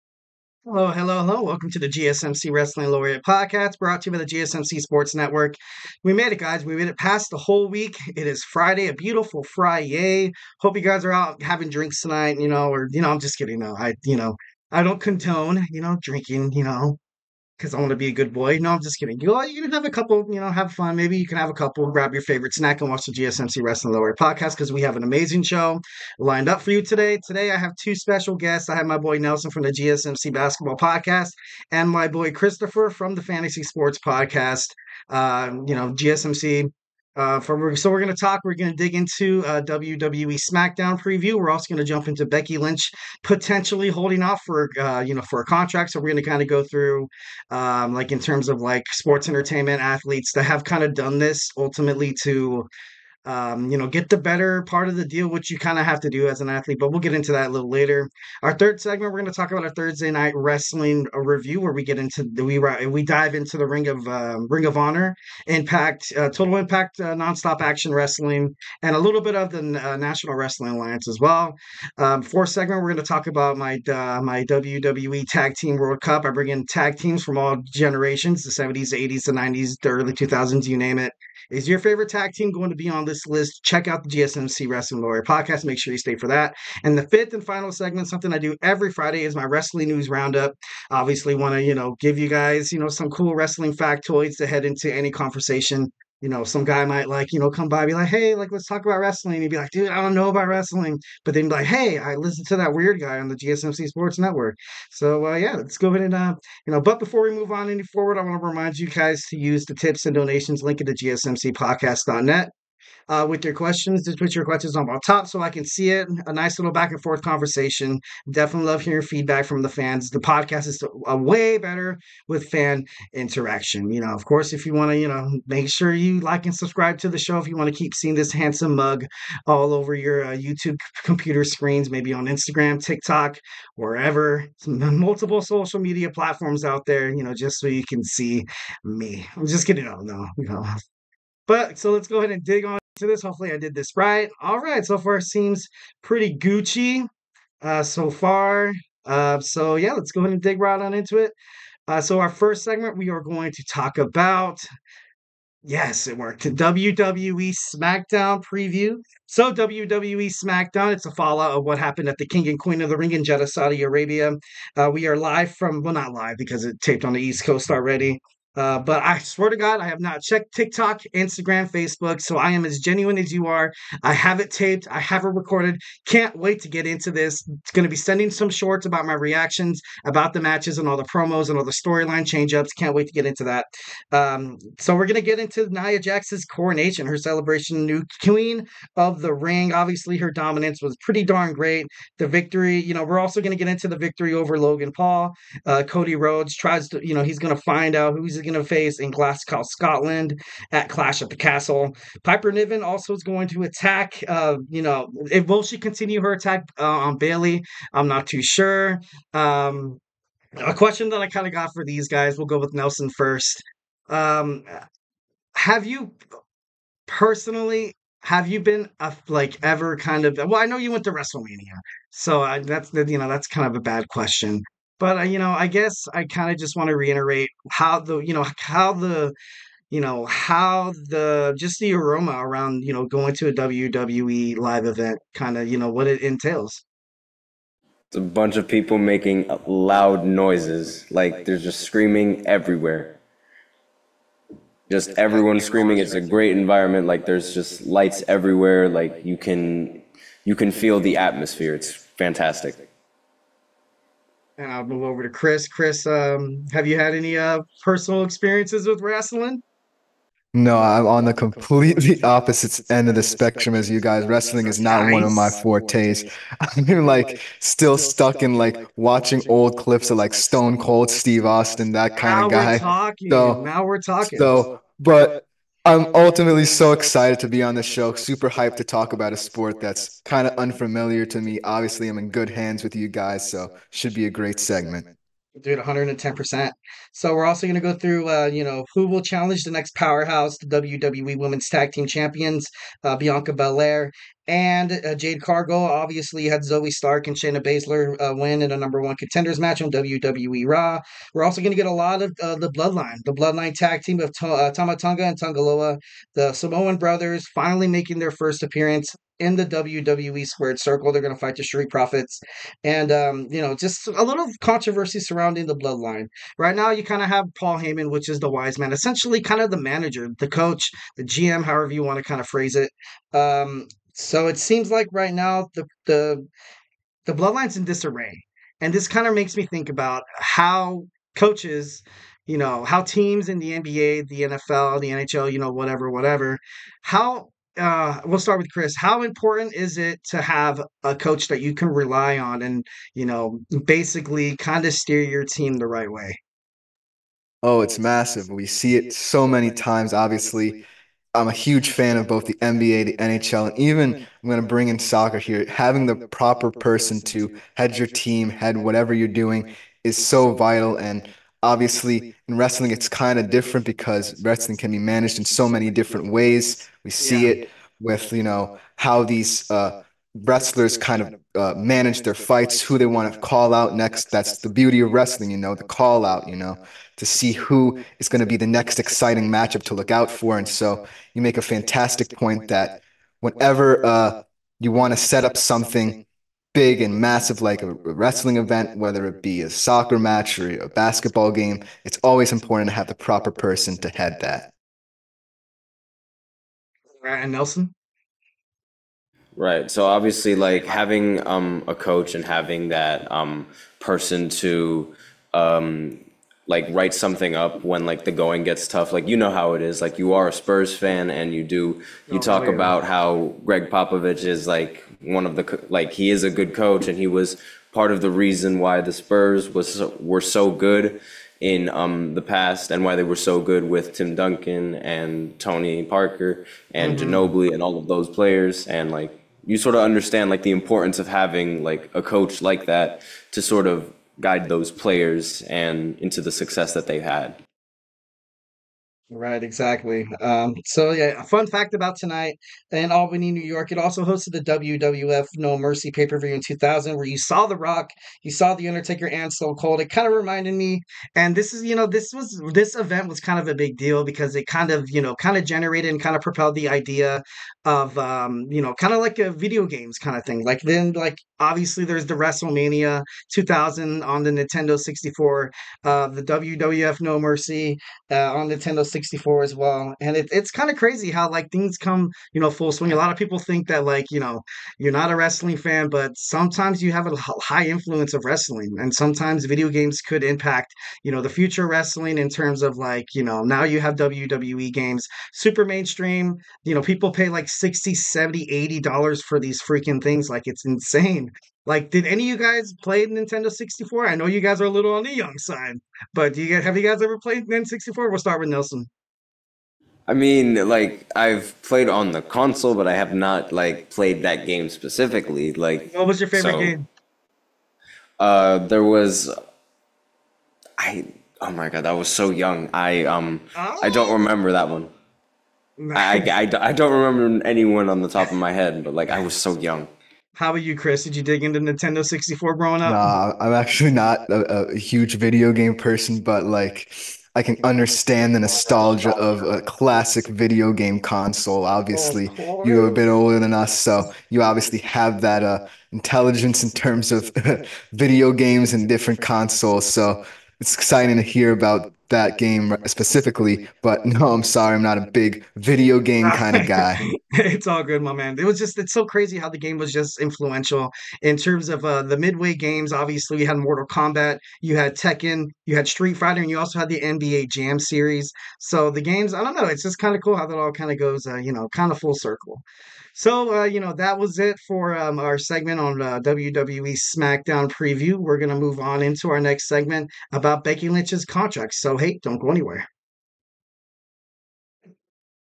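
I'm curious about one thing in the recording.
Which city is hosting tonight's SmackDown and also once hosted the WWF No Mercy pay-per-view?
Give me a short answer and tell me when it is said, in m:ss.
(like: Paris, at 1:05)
Albany, New York, at 7:23.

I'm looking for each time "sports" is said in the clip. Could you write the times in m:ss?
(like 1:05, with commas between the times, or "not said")
0:04, 0:33, 0:48, 1:43, 4:39.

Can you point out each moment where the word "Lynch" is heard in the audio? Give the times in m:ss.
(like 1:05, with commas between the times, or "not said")
0:42, 9:31.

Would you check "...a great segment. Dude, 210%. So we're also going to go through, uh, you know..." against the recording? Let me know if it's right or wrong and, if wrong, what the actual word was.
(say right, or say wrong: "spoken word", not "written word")
wrong: "110", not "210".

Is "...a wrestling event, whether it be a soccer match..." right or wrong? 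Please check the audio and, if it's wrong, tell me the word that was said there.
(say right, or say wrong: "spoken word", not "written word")
right.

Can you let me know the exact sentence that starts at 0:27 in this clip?
Today, I have two special guests.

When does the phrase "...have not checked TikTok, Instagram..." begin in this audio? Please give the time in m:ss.
2:49.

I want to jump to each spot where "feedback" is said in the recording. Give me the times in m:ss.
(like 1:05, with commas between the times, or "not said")
1:59.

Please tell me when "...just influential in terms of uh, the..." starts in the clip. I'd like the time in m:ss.
9:10.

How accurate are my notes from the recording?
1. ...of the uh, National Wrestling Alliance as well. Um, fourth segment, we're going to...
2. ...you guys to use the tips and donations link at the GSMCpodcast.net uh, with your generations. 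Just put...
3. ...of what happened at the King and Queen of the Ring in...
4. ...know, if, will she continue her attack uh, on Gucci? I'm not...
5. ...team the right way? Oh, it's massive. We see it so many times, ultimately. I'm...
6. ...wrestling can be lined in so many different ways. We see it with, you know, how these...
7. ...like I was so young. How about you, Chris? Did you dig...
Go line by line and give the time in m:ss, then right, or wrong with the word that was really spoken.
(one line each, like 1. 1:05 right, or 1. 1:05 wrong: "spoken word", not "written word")
1. 1:09 right
2. 1:48 wrong: "questions", not "generations"
3. 2:41 right
4. 3:24 wrong: "Bayley", not "Gucci"
5. 5:45 wrong: "obviously", not "ultimately"
6. 6:04 wrong: "managed", not "lined"
7. 8:39 right.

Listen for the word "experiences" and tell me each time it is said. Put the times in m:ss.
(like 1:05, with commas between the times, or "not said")
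4:18.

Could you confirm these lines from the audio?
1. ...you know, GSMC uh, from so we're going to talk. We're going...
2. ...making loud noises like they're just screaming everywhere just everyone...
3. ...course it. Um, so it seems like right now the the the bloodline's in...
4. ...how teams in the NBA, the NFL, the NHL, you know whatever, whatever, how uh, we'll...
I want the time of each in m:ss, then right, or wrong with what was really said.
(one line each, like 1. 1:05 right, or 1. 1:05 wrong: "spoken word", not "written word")
1. 0:35 right
2. 3:58 right
3. 5:22 wrong: "phrase", not "course"
4. 5:32 right.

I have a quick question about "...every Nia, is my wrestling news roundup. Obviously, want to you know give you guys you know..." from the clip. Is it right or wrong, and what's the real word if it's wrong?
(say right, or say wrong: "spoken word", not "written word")
wrong: "Friday", not "Nia".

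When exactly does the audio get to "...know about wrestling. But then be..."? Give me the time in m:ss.
1:40.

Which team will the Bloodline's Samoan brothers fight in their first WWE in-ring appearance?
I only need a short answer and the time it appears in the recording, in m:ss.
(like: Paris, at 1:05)
The Street Profits, at 5:11.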